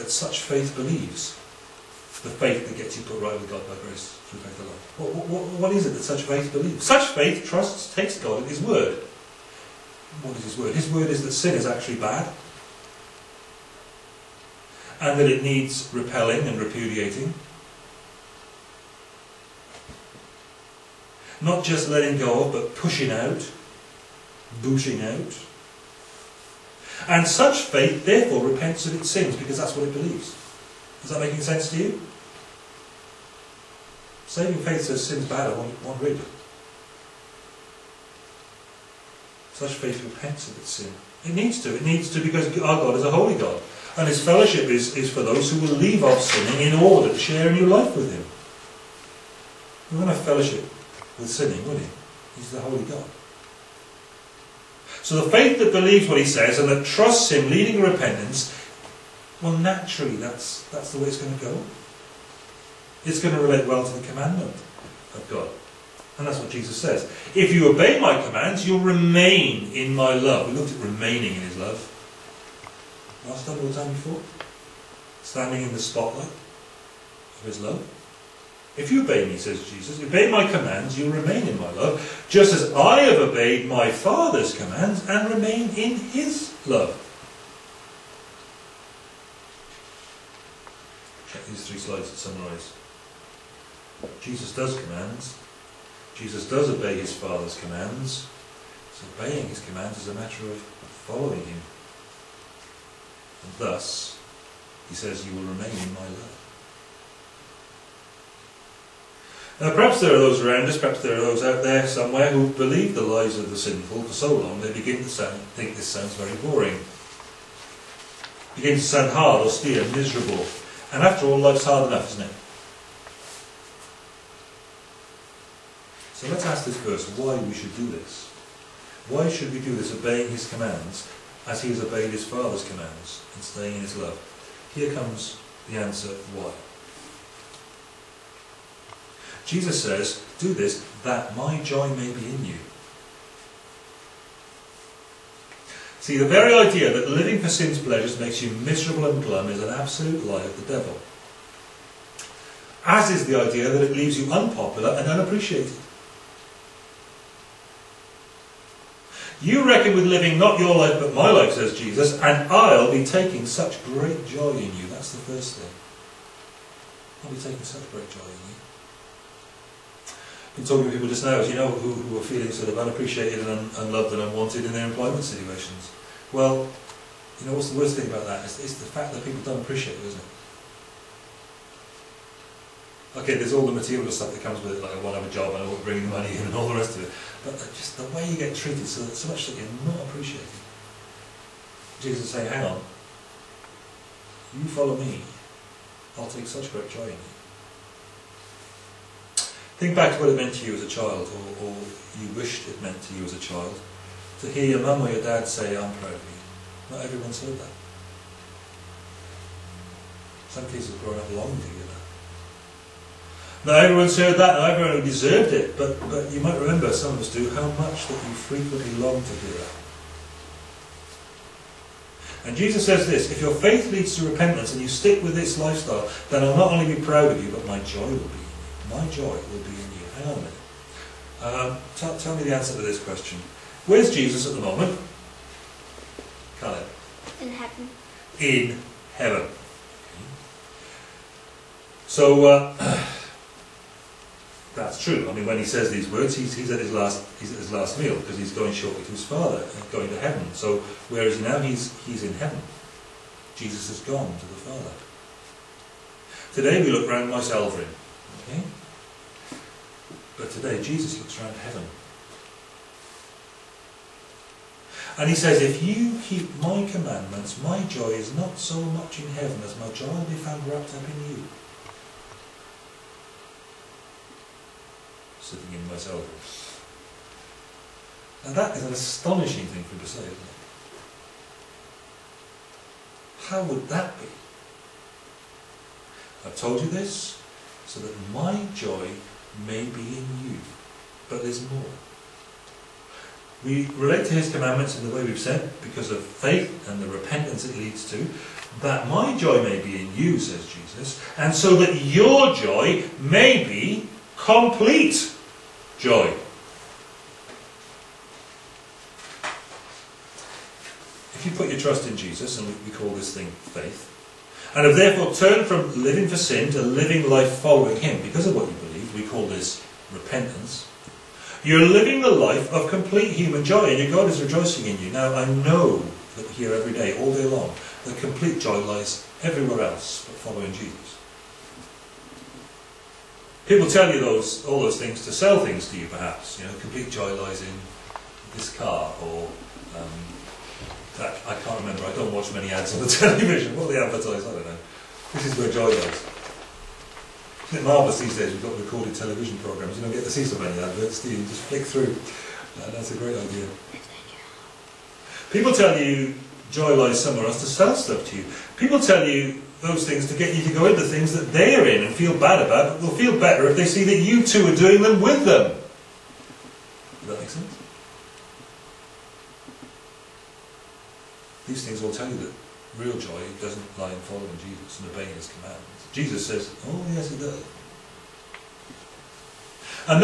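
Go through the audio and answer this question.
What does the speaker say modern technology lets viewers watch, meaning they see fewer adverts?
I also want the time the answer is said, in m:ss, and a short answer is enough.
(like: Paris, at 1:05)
recorded television programmes, at 5:48.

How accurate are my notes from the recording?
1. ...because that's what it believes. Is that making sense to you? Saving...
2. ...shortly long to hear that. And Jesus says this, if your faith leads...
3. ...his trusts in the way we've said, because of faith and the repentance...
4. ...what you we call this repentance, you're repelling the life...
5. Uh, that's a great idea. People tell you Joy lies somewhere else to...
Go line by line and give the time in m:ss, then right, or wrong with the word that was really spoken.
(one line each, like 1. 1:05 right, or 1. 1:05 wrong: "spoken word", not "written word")
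1. 0:29 right
2. 3:38 wrong: "frequently", not "shortly"
3. 4:54 wrong: "commandments", not "trusts"
4. 5:18 wrong: "living", not "repelling"
5. 5:52 right.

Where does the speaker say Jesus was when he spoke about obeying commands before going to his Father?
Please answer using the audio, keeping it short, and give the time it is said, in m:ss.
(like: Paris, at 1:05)
his last meal, at 4:07.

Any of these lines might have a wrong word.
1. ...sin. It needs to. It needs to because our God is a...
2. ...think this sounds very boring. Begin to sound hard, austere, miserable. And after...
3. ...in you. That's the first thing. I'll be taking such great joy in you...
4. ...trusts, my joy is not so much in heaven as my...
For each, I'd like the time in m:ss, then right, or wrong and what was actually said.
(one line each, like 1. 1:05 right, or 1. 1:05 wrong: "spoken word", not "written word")
1. 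0:40 right
2. 1:55 right
3. 2:44 right
4. 4:26 wrong: "commandments", not "trusts".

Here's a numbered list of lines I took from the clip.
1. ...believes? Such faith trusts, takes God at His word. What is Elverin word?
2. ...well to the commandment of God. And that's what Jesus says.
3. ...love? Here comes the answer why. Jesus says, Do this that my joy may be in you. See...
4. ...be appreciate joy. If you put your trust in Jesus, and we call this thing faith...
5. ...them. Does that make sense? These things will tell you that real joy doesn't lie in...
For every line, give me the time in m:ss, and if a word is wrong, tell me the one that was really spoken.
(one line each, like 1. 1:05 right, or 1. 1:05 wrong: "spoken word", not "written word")
1. 0:06 wrong: "His", not "Elverin"
2. 1:03 right
3. 2:13 right
4. 5:03 wrong: "complete", not "appreciate"
5. 6:05 right.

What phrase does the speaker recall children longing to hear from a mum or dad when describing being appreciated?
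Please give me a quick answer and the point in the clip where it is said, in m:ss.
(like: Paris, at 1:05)
I'm proud of you, at 3:25.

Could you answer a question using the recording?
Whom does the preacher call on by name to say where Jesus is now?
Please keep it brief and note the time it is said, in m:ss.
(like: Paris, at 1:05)
Colin, at 3:56.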